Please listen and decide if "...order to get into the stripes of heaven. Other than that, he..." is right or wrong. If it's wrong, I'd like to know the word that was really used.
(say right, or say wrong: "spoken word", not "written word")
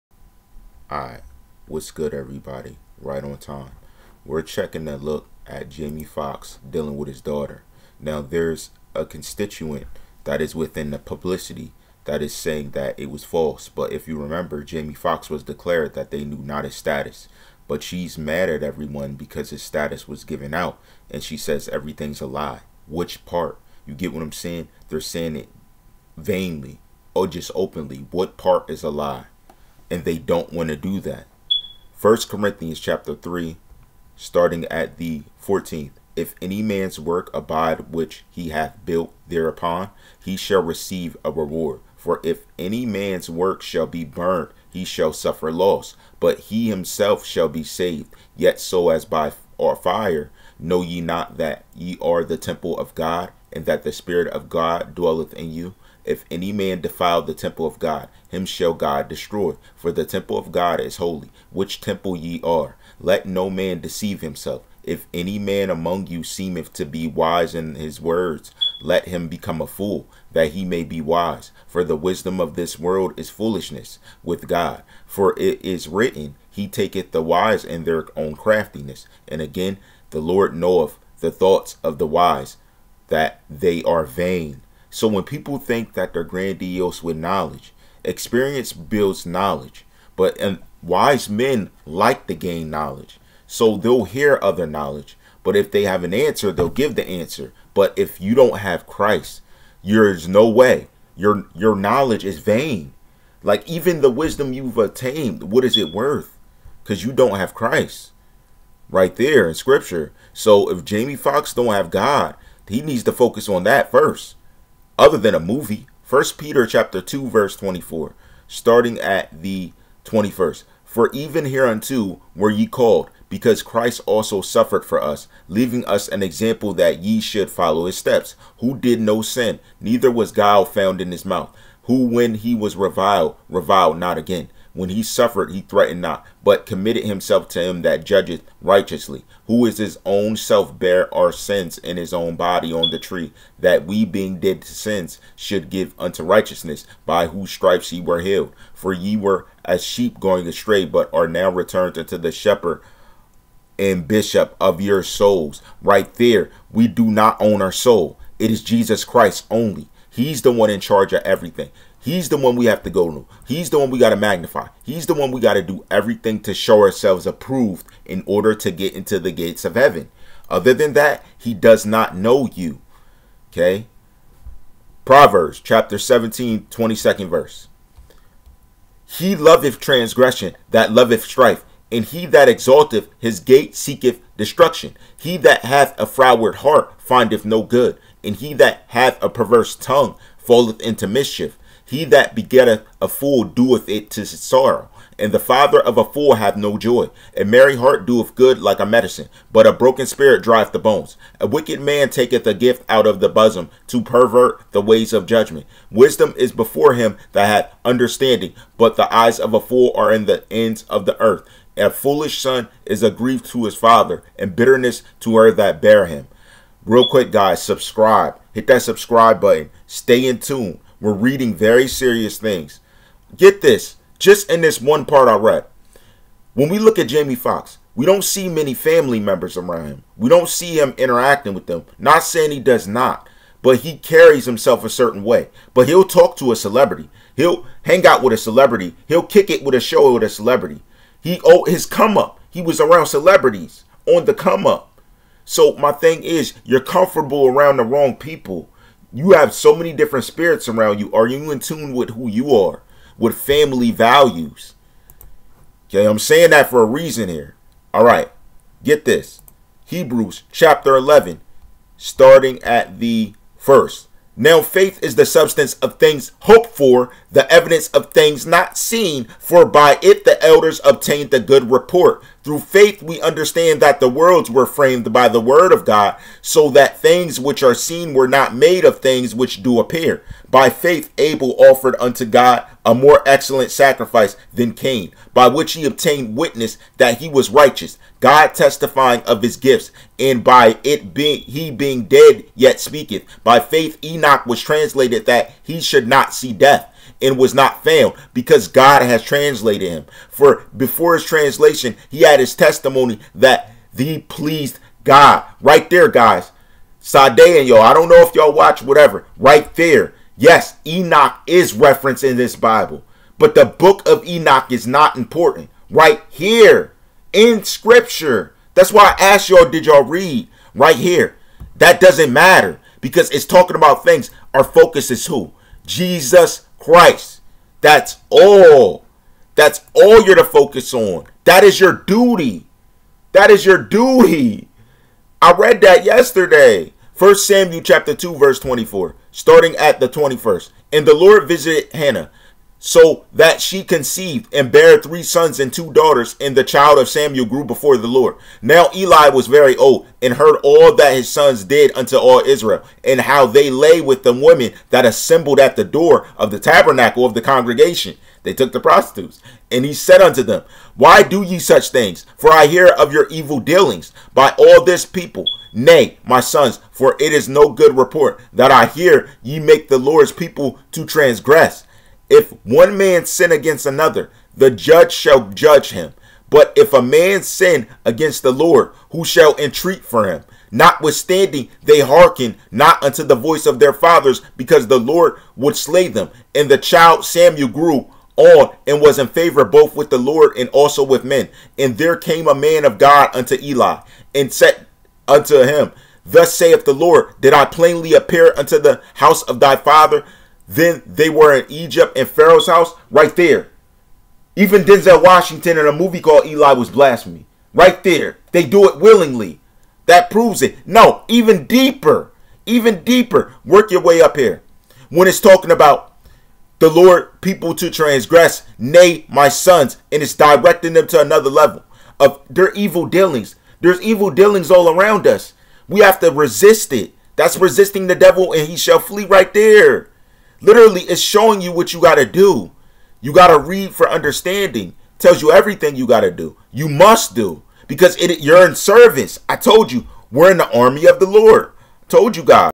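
wrong: "gates", not "stripes".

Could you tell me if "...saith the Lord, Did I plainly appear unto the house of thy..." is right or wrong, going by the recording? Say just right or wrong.
right.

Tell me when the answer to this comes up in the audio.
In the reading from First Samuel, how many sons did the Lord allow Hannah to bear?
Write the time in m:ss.
5:44.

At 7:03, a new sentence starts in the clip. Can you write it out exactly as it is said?
There's evil dealings all around us.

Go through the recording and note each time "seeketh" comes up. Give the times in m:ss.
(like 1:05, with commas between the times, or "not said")
3:03.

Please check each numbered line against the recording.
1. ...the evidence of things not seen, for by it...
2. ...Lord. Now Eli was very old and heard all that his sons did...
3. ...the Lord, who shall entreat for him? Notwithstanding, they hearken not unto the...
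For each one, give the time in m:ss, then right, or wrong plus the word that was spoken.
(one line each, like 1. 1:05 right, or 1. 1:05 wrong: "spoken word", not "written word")
1. 4:27 right
2. 5:48 right
3. 6:18 right.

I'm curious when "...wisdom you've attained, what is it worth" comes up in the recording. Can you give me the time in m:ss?
1:44.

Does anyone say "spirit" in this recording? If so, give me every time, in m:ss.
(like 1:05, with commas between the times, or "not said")
0:53, 3:20, 4:10.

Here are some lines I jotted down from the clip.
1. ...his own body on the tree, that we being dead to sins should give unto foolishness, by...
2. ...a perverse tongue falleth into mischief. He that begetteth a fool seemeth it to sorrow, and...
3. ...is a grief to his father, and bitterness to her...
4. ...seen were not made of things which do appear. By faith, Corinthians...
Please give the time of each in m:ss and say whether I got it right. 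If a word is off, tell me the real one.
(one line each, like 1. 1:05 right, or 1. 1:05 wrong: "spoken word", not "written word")
1. 2:21 wrong: "righteousness", not "foolishness"
2. 3:09 wrong: "doeth", not "seemeth"
3. 3:32 right
4. 4:37 wrong: "Abel", not "Corinthians".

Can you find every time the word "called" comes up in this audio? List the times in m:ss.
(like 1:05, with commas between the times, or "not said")
2:02, 6:46.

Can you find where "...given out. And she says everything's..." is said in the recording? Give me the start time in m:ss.
0:20.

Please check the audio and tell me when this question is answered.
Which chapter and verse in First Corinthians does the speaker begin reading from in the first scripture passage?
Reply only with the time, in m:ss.
0:31.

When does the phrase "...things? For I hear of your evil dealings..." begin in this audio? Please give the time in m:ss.
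6:01.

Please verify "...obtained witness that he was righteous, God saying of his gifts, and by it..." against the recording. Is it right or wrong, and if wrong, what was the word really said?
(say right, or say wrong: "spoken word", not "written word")
wrong: "testifying", not "saying".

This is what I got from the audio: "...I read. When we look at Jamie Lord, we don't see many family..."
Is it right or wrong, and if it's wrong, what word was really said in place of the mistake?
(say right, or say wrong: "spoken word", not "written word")
wrong: "Foxx", not "Lord".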